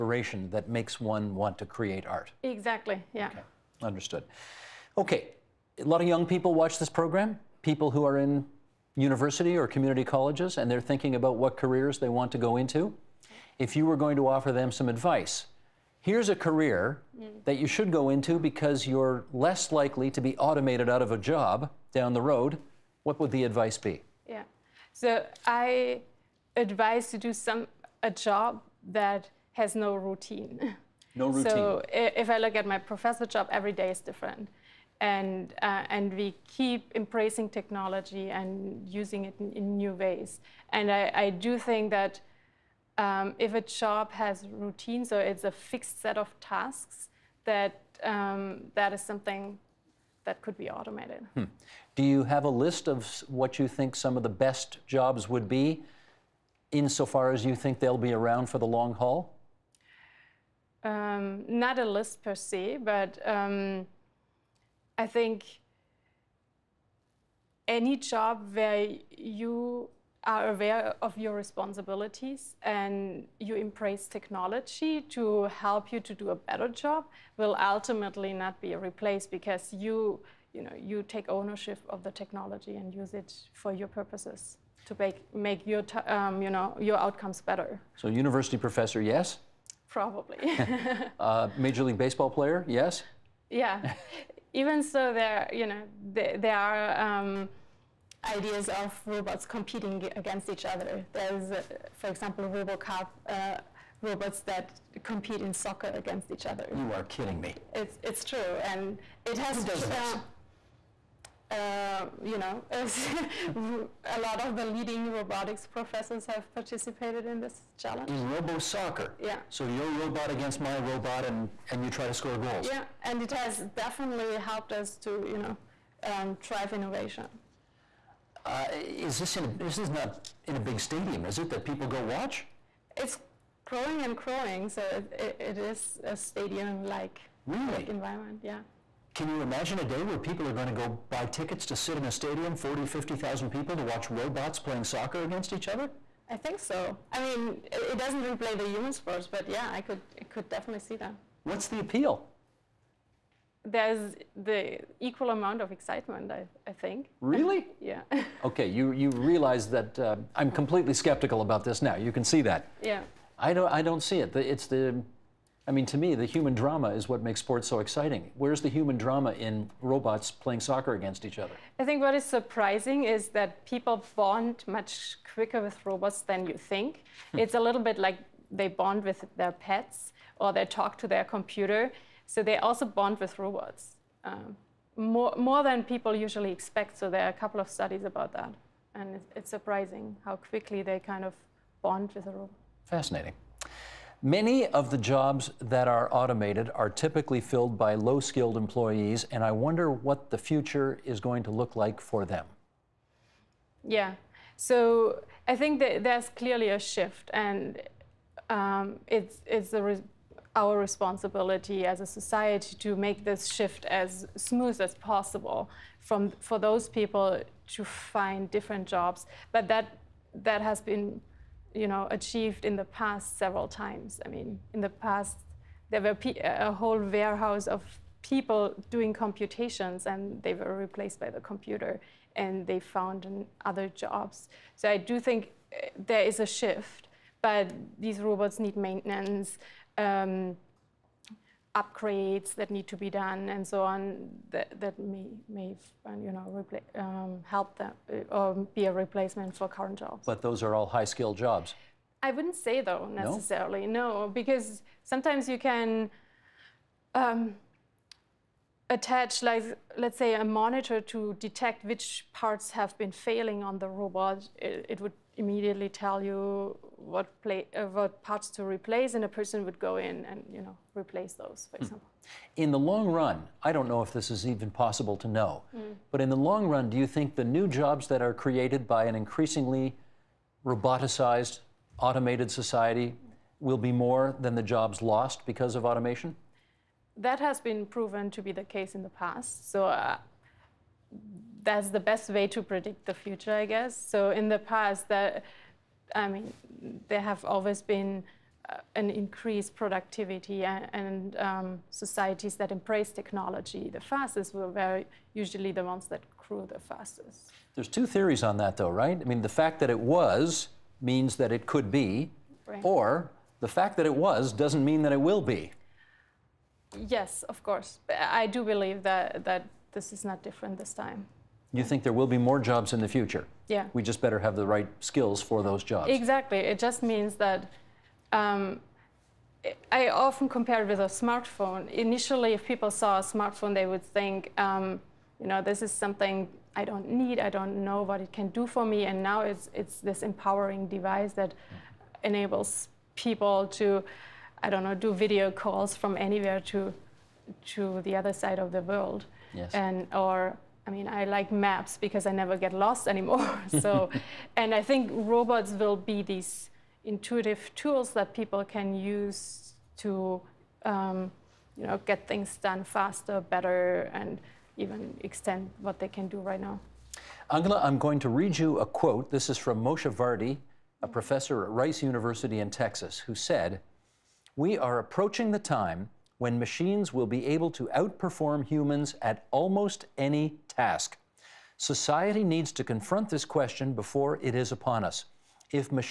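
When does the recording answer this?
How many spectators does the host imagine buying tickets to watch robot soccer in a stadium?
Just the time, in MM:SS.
02:22.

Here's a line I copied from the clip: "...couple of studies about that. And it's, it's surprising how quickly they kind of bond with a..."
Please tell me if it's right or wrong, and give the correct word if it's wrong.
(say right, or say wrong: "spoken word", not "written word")
right.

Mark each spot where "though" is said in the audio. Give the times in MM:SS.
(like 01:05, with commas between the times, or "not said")
04:12, 05:08.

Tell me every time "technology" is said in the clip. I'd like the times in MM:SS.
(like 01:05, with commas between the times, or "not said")
00:37, 01:14, 01:22, 05:03.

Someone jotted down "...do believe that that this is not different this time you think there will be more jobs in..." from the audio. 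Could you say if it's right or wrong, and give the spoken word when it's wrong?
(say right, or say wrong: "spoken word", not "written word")
right.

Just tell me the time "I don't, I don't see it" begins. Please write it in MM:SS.
02:43.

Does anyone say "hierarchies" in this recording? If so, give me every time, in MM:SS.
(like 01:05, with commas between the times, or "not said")
not said.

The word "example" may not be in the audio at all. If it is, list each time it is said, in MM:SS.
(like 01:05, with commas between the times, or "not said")
01:42, 04:31.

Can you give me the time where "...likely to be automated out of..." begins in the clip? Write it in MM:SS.
00:19.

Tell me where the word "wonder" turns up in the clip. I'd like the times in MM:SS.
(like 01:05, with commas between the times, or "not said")
03:19.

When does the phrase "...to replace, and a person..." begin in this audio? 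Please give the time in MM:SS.
04:28.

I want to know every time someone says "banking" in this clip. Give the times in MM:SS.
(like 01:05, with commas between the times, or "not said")
not said.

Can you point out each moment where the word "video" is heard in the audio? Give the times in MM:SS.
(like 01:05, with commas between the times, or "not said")
05:45.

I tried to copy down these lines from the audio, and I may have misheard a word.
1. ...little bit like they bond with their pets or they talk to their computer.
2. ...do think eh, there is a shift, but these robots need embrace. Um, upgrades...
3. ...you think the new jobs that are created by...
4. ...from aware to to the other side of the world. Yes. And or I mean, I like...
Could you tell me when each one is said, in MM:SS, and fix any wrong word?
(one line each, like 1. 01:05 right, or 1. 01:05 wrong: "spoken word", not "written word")
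1. 02:57 right
2. 03:54 wrong: "maintenance", not "embrace"
3. 04:36 right
4. 05:45 wrong: "anywhere", not "aware".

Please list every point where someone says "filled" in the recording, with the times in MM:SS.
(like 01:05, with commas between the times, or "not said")
03:17.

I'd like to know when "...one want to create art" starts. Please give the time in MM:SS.
00:01.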